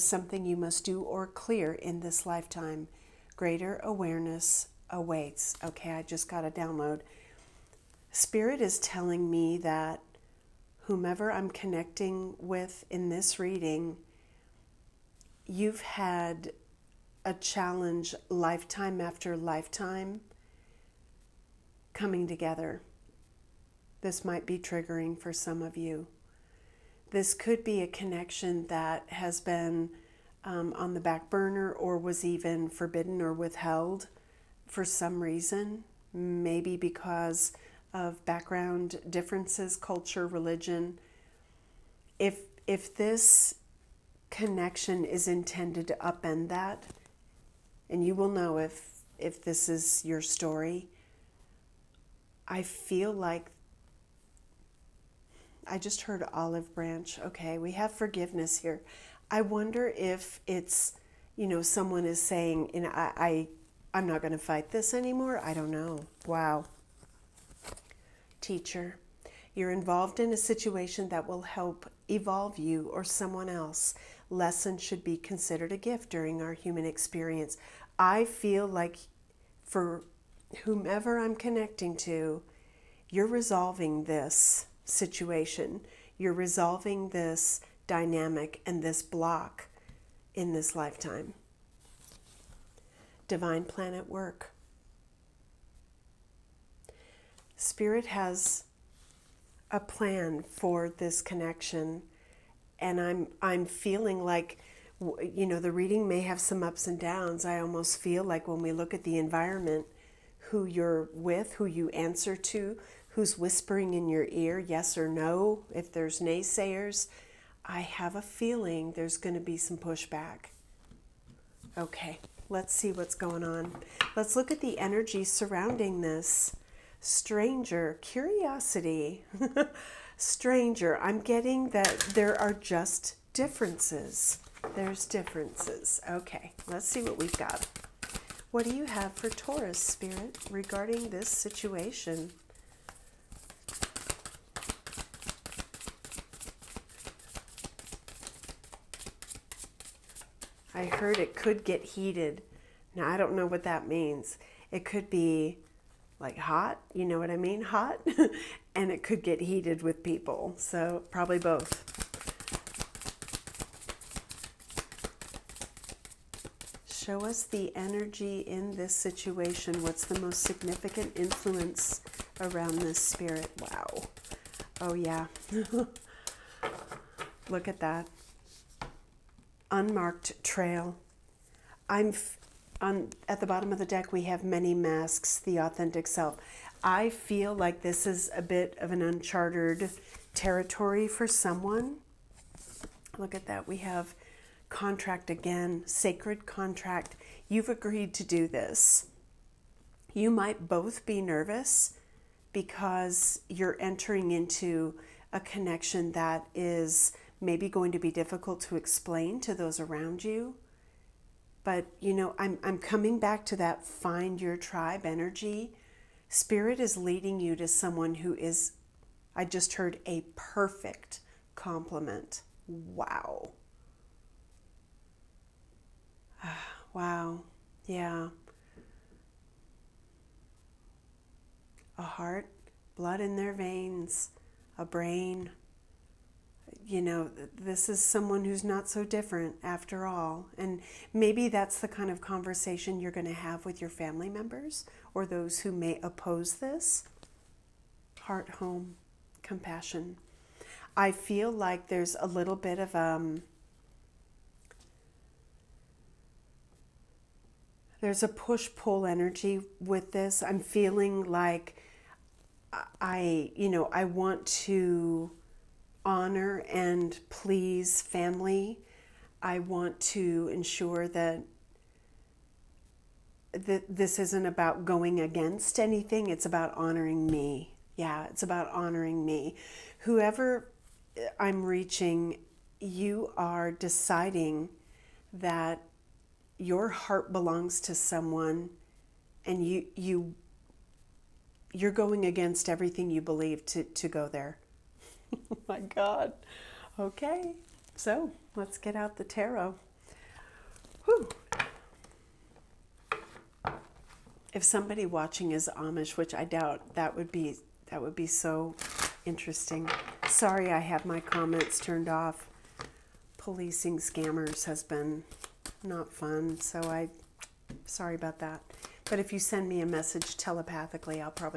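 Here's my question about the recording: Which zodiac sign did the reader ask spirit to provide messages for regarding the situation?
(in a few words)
Taurus.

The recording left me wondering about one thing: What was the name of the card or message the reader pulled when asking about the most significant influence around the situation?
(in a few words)
Unmarked trail.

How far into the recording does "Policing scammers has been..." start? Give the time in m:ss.
5:13.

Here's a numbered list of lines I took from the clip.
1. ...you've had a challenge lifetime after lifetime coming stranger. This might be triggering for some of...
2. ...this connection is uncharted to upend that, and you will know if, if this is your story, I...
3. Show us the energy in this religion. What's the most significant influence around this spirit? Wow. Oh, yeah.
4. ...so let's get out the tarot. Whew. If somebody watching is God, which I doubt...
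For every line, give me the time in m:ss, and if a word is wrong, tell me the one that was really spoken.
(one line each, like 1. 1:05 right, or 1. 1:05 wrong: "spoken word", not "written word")
1. 0:15 wrong: "together", not "stranger"
2. 0:42 wrong: "intended", not "uncharted"
3. 2:46 wrong: "situation", not "religion"
4. 4:57 wrong: "Amish", not "God".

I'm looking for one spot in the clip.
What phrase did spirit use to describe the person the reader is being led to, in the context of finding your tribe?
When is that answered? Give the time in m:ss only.
3:40.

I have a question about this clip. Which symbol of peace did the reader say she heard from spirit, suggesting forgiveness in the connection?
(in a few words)
Olive branch.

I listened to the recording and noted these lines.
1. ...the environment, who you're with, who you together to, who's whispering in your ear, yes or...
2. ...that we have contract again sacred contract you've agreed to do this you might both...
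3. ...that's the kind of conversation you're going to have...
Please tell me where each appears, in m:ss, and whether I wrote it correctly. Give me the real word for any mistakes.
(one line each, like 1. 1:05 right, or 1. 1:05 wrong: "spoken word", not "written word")
1. 1:49 wrong: "answer", not "together"
2. 3:13 right
3. 4:01 right.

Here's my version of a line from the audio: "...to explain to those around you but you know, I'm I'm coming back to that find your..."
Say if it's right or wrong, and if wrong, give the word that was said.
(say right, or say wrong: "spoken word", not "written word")
right.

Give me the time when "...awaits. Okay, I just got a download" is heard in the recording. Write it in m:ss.
0:04.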